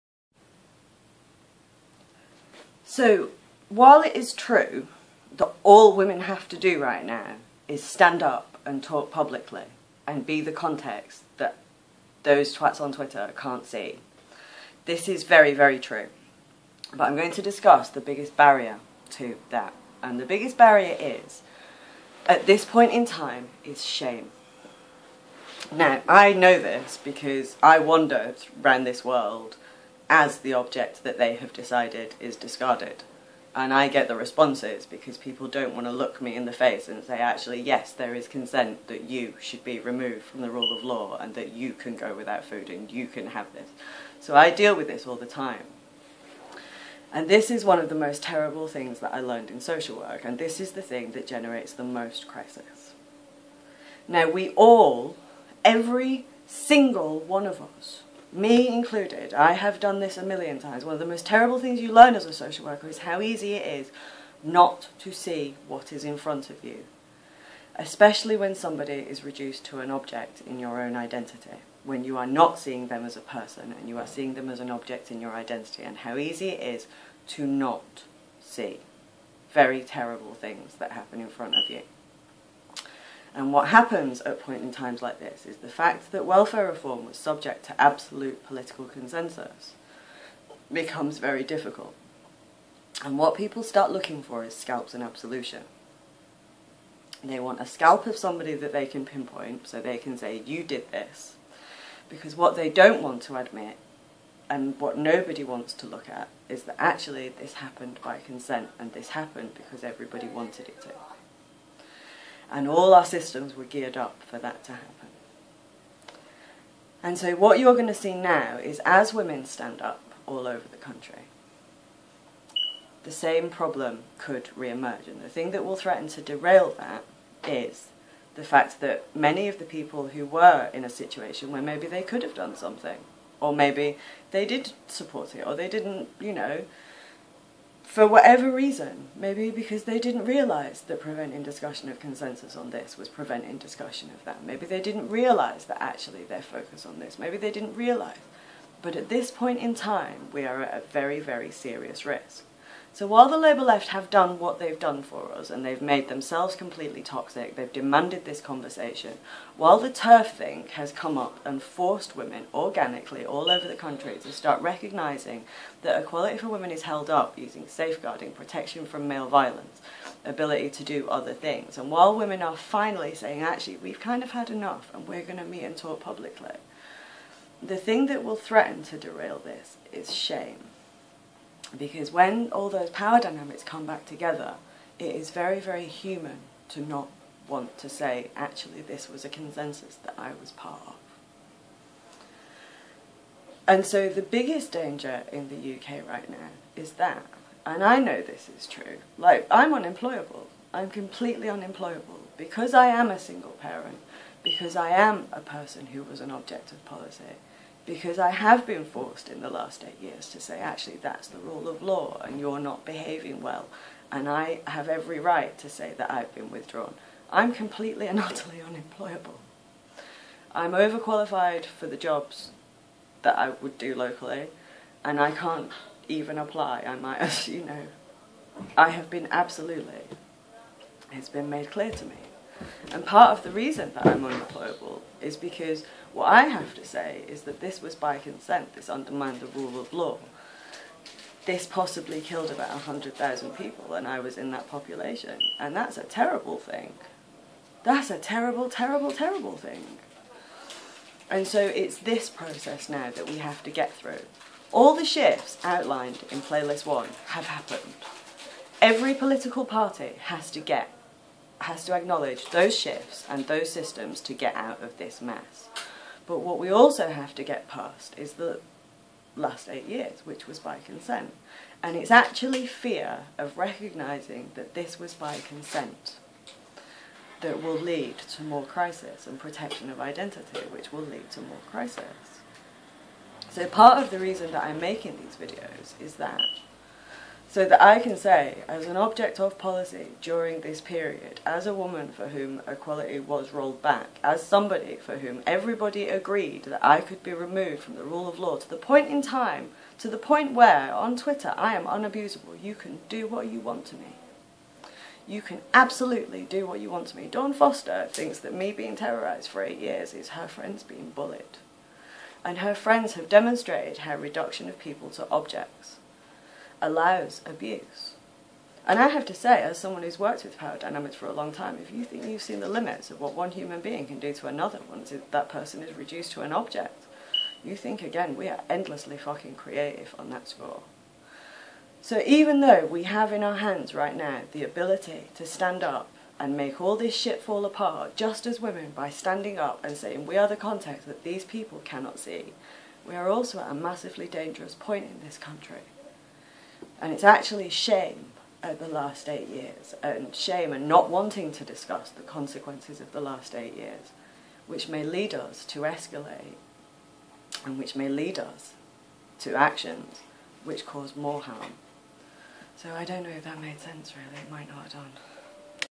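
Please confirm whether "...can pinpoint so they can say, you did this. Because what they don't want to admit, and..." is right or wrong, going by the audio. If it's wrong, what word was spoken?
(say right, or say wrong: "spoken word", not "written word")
right.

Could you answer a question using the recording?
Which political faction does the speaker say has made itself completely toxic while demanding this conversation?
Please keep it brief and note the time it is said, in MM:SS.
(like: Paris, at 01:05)
Labour left, at 02:33.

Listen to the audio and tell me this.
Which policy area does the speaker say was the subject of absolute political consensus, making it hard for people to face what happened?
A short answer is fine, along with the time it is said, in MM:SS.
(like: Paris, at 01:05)
welfare reform, at 01:26.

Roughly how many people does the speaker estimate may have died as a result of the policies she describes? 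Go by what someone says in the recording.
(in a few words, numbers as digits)
100,000.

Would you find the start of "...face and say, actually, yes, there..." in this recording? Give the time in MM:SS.
00:36.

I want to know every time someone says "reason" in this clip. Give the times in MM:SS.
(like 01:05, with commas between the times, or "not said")
02:18, 03:53, 04:44.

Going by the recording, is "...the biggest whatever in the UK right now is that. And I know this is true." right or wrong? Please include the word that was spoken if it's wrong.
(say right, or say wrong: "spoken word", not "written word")
wrong: "danger", not "whatever".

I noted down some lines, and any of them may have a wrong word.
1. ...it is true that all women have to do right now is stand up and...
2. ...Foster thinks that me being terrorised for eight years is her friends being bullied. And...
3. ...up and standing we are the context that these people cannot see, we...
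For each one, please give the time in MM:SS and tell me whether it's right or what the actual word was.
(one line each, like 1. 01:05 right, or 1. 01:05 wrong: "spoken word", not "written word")
1. 00:04 right
2. 05:07 right
3. 05:39 wrong: "saying", not "standing".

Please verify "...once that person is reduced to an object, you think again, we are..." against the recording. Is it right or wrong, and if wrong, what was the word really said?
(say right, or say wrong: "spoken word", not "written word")
right.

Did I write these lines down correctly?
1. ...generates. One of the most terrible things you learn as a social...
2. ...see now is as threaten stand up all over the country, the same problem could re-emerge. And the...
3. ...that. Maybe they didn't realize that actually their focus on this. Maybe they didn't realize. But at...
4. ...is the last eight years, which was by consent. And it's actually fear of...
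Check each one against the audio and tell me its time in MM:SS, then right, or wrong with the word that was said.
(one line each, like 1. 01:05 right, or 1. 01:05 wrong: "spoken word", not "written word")
1. 01:00 wrong: "times", not "generates"
2. 01:57 wrong: "women", not "threaten"
3. 02:24 right
4. 04:28 right.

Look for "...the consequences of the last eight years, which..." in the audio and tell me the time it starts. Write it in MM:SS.
05:52.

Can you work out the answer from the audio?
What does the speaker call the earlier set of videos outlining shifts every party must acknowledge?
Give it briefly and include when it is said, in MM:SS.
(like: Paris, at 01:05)
Playlist 1, at 04:16.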